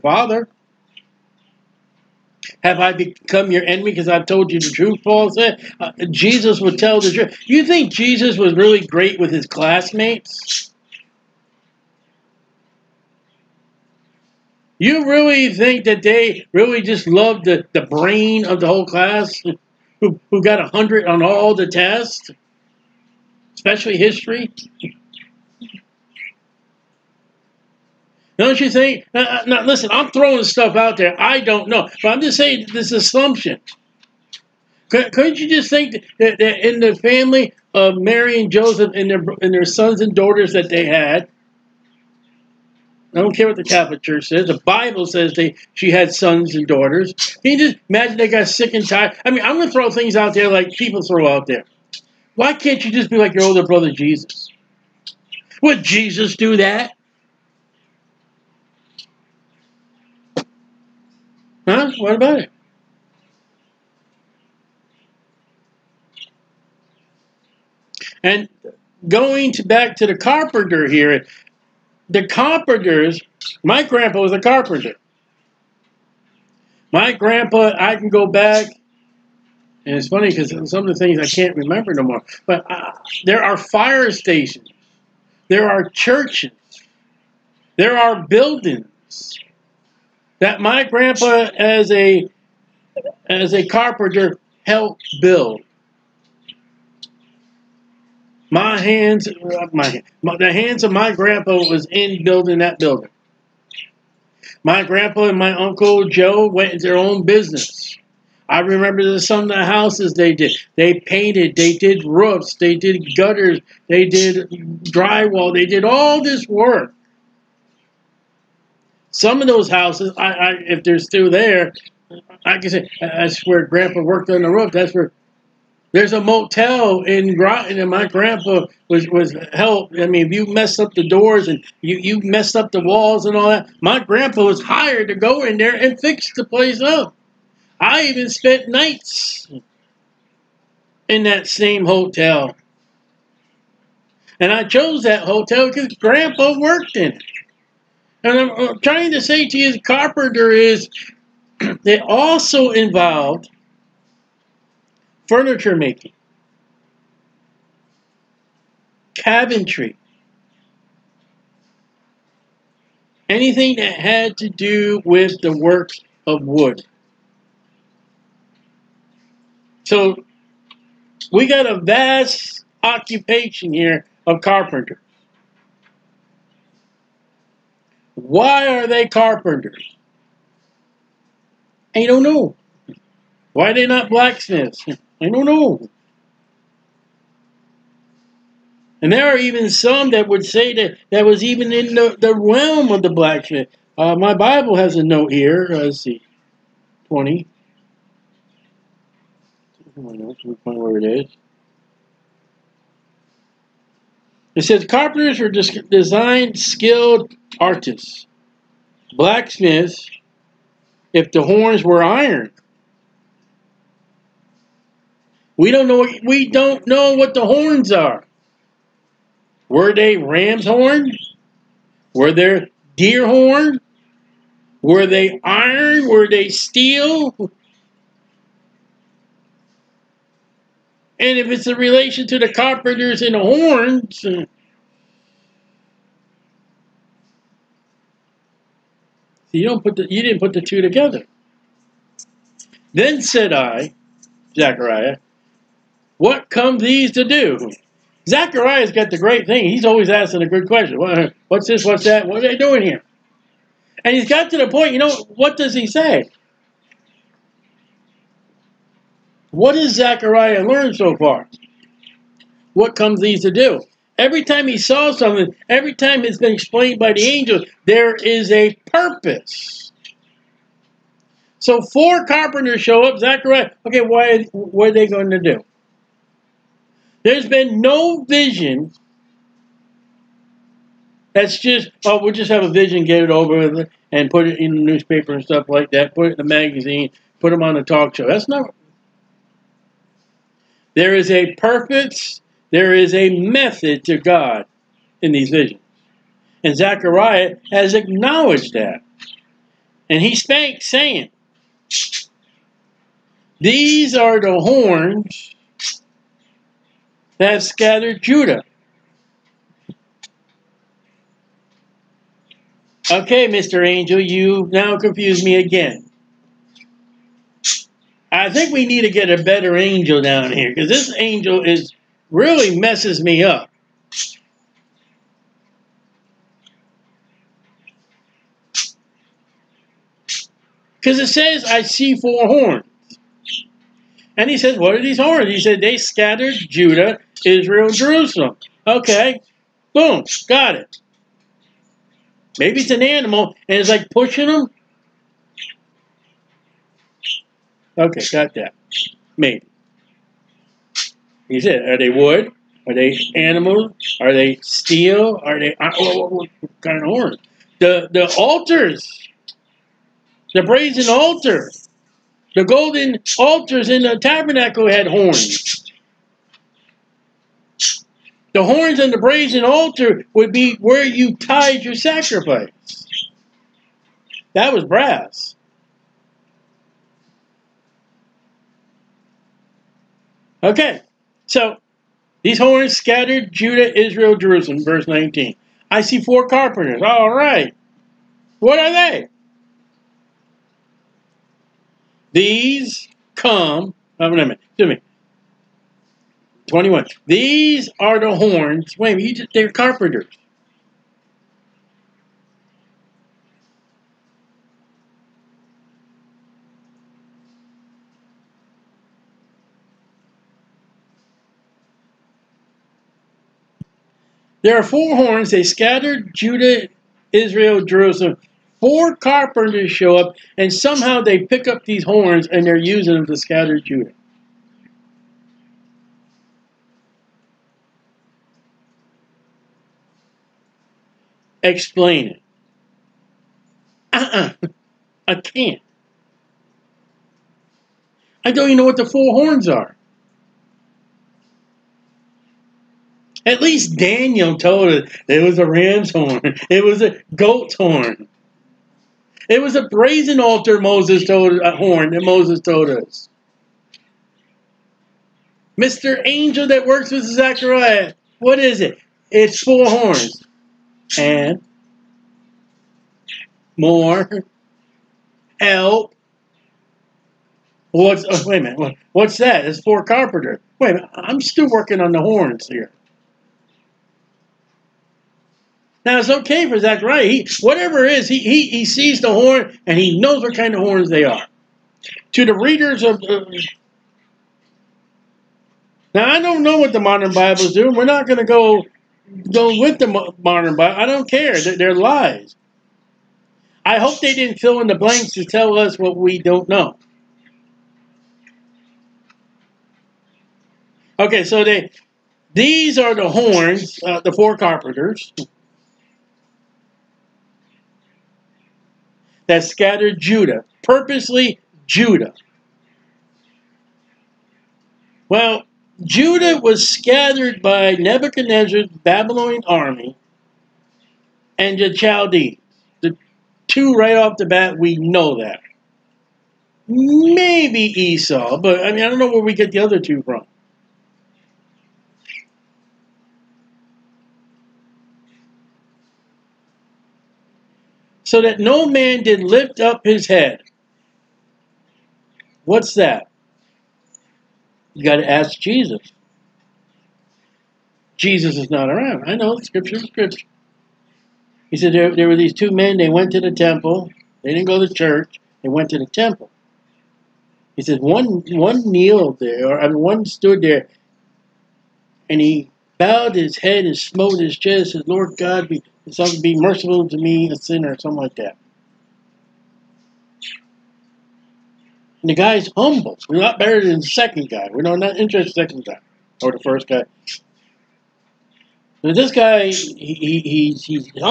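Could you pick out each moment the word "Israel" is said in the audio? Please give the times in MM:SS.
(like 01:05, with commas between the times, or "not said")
05:37, 06:23, 06:57.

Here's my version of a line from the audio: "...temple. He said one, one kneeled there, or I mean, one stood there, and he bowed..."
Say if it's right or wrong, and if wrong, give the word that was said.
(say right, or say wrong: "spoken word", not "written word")
right.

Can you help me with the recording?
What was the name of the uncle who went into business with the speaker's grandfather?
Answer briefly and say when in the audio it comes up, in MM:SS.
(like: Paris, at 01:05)
Uncle Joe, at 01:45.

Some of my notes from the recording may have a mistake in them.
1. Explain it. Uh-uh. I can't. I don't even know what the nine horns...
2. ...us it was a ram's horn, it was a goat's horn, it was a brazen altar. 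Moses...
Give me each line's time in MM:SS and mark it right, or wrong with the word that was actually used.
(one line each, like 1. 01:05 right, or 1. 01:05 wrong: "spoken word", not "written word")
1. 07:11 wrong: "four", not "nine"
2. 07:24 right.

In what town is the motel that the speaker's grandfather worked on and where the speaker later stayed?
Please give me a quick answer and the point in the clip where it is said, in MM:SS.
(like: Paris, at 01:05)
Groton, at 02:07.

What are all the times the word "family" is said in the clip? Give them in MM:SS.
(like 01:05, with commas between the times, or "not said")
00:36.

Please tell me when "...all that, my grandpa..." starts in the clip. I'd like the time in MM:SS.
02:13.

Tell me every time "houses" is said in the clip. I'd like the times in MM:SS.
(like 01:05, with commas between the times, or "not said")
01:49, 01:59.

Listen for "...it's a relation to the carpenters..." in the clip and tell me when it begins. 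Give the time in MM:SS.
03:51.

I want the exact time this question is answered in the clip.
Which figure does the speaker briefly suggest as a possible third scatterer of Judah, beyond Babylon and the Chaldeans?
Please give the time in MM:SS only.
08:47.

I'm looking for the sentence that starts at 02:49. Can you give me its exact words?
So we got a vast occupation here of carpenter.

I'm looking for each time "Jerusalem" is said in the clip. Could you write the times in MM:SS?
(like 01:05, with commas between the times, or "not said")
05:37, 06:24, 06:57.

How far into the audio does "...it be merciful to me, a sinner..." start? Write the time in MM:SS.
09:26.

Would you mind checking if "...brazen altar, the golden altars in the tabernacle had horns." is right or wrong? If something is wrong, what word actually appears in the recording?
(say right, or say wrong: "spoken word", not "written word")
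right.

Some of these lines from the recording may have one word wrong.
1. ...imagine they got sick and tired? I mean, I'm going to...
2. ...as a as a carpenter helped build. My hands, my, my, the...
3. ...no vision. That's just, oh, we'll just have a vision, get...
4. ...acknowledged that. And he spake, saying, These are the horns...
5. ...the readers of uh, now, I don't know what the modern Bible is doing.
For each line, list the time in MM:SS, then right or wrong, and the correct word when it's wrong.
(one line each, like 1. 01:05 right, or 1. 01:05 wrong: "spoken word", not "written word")
1. 00:47 right
2. 01:31 right
3. 04:37 right
4. 04:57 right
5. 08:02 right.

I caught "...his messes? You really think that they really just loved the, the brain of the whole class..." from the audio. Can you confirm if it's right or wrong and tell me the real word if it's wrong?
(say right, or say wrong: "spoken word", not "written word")
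wrong: "classmates", not "messes".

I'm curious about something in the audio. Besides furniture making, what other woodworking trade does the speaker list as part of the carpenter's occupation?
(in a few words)
cabinetry.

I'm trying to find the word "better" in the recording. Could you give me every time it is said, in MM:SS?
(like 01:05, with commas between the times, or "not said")
05:19, 09:33.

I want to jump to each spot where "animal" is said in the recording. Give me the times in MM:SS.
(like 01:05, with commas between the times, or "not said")
05:43, 05:53.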